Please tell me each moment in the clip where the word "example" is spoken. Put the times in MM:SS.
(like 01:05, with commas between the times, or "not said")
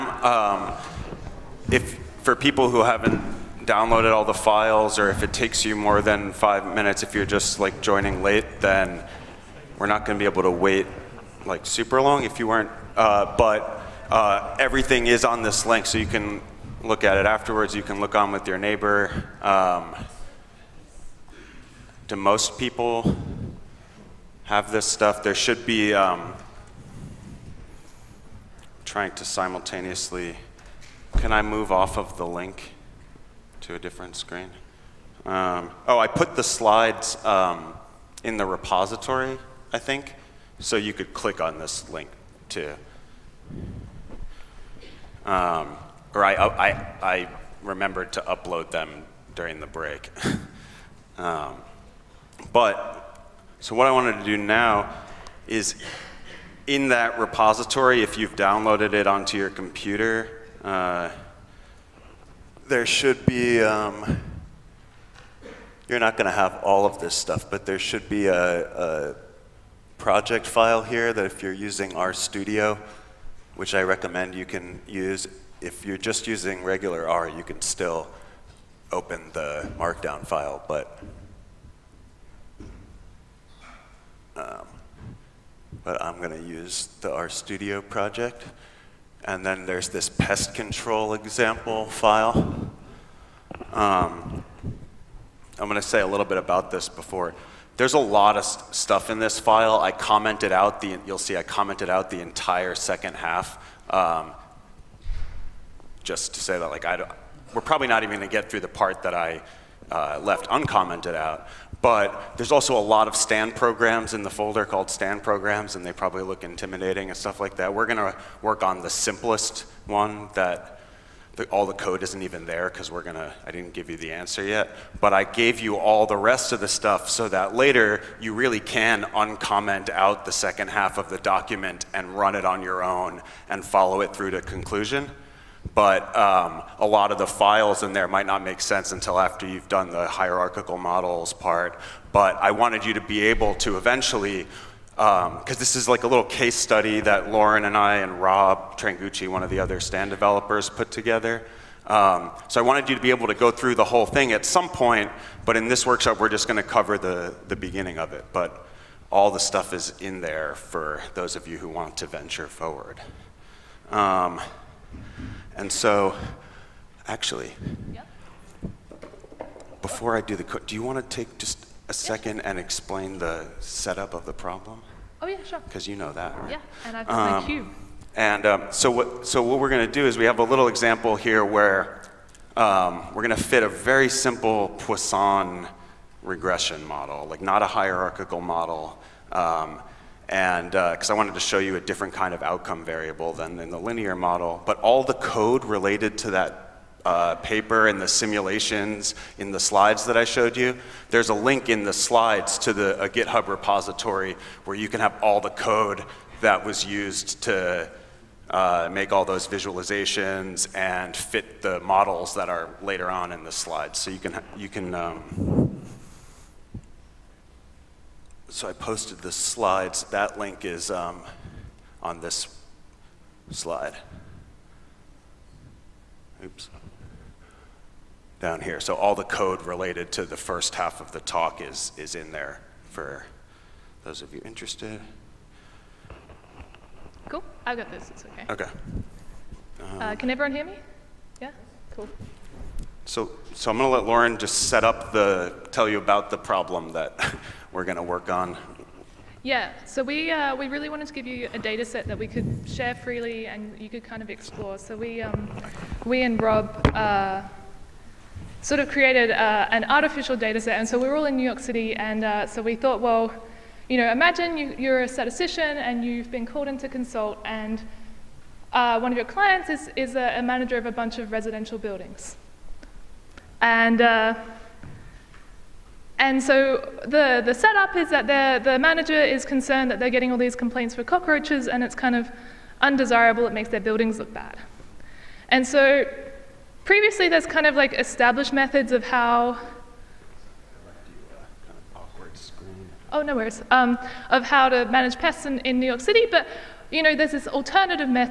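01:31, 03:00.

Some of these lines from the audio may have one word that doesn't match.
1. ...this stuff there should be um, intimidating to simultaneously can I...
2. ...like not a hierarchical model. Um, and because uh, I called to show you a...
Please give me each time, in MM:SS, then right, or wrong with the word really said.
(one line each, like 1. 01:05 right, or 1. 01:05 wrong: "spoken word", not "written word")
1. 00:24 wrong: "trying", not "intimidating"
2. 03:07 wrong: "wanted", not "called".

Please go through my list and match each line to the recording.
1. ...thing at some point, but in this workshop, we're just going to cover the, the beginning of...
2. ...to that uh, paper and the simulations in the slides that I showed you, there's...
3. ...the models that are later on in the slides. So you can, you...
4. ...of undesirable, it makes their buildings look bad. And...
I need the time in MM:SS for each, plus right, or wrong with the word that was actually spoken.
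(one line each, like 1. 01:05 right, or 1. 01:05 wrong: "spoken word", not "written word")
1. 02:34 right
2. 03:16 right
3. 03:31 right
4. 04:42 right.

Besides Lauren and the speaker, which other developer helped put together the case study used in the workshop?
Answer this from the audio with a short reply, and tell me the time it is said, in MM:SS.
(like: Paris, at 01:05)
Rob Trangucci, at 02:28.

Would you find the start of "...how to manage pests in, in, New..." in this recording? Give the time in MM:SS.
04:54.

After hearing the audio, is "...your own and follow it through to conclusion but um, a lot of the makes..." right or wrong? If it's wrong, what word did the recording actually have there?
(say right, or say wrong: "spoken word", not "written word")
wrong: "files", not "makes".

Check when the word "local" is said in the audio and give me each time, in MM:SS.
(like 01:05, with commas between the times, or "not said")
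not said.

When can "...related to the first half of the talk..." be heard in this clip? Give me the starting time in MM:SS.
03:49.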